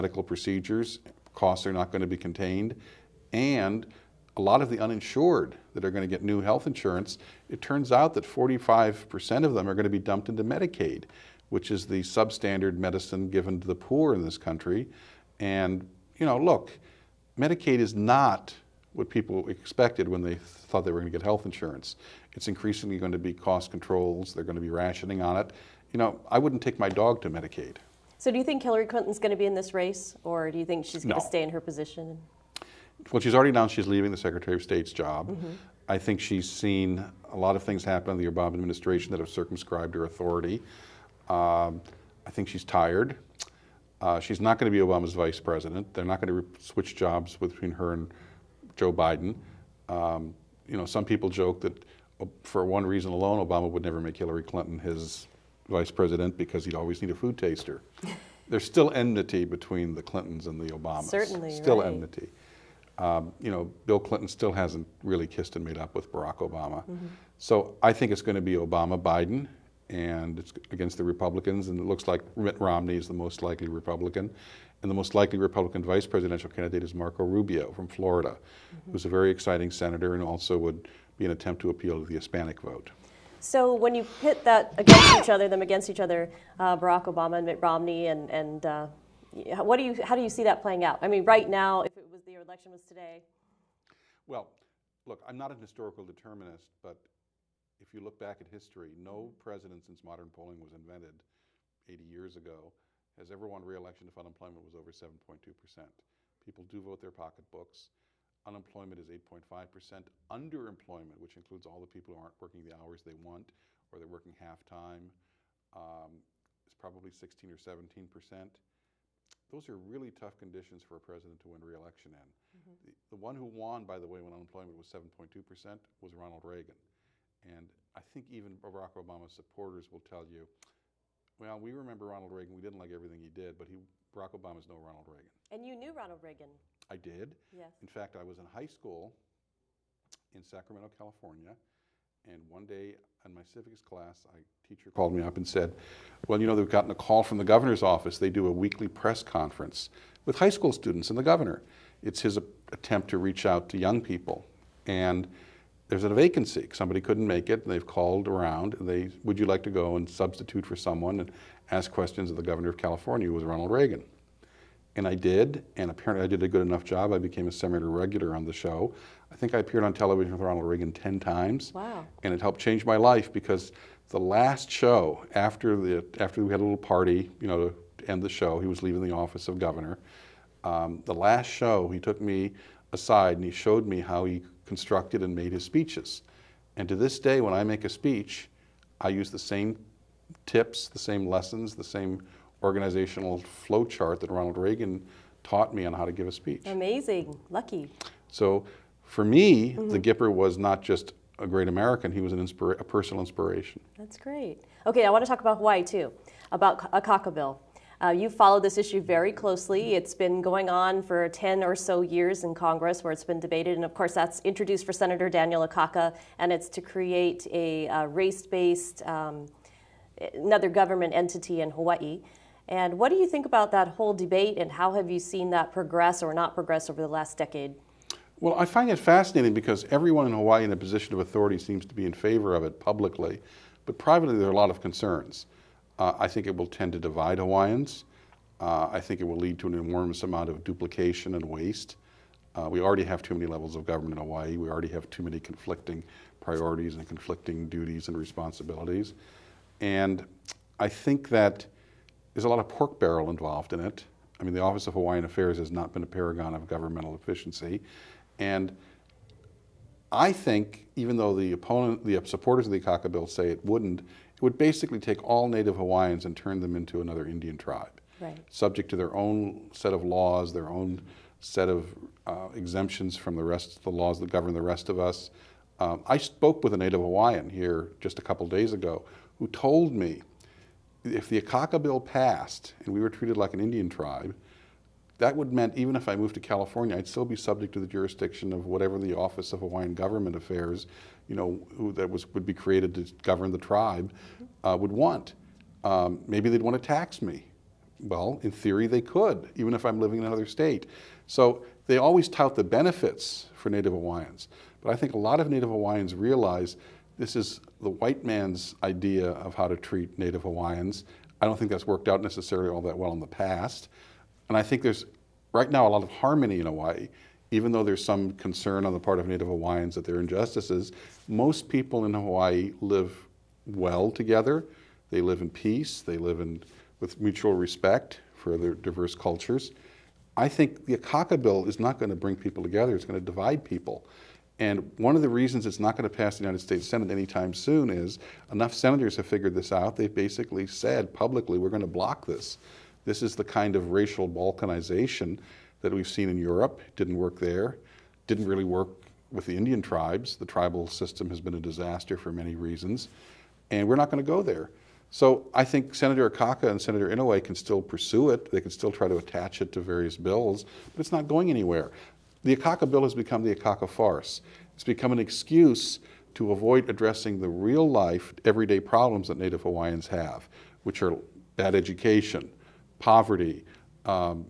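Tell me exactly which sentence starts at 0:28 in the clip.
So, do you think Hillary Clinton's going to be in this race, or do you think she's going no.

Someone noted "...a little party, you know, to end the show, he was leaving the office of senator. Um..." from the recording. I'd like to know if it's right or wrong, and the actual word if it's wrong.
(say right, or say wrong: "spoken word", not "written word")
wrong: "governor", not "senator".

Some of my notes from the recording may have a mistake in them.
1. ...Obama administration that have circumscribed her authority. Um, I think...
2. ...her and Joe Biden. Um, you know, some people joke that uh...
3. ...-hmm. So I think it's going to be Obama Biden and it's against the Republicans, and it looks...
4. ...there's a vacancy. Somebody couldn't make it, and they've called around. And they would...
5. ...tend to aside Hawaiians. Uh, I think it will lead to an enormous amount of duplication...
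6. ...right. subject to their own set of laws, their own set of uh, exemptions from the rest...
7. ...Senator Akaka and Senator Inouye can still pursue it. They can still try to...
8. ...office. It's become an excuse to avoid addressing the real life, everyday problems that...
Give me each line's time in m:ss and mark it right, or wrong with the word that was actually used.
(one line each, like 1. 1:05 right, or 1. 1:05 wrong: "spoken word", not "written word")
1. 0:38 right
2. 0:47 right
3. 1:06 right
4. 2:35 right
5. 3:56 wrong: "divide", not "aside"
6. 4:28 right
7. 5:55 right
8. 6:03 wrong: "farce", not "office".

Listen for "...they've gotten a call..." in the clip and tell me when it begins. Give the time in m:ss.
2:26.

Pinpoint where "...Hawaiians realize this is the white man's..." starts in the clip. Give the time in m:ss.
5:05.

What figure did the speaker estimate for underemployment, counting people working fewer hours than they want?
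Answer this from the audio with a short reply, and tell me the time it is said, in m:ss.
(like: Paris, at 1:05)
16 or 17%, at 1:57.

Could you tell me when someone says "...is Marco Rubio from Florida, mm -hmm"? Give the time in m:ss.
1:16.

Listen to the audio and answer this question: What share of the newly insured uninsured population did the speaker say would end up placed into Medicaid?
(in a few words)
45%.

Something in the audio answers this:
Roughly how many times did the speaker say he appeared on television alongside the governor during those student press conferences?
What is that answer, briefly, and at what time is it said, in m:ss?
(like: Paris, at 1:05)
10, at 2:50.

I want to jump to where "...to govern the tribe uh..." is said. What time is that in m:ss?
4:52.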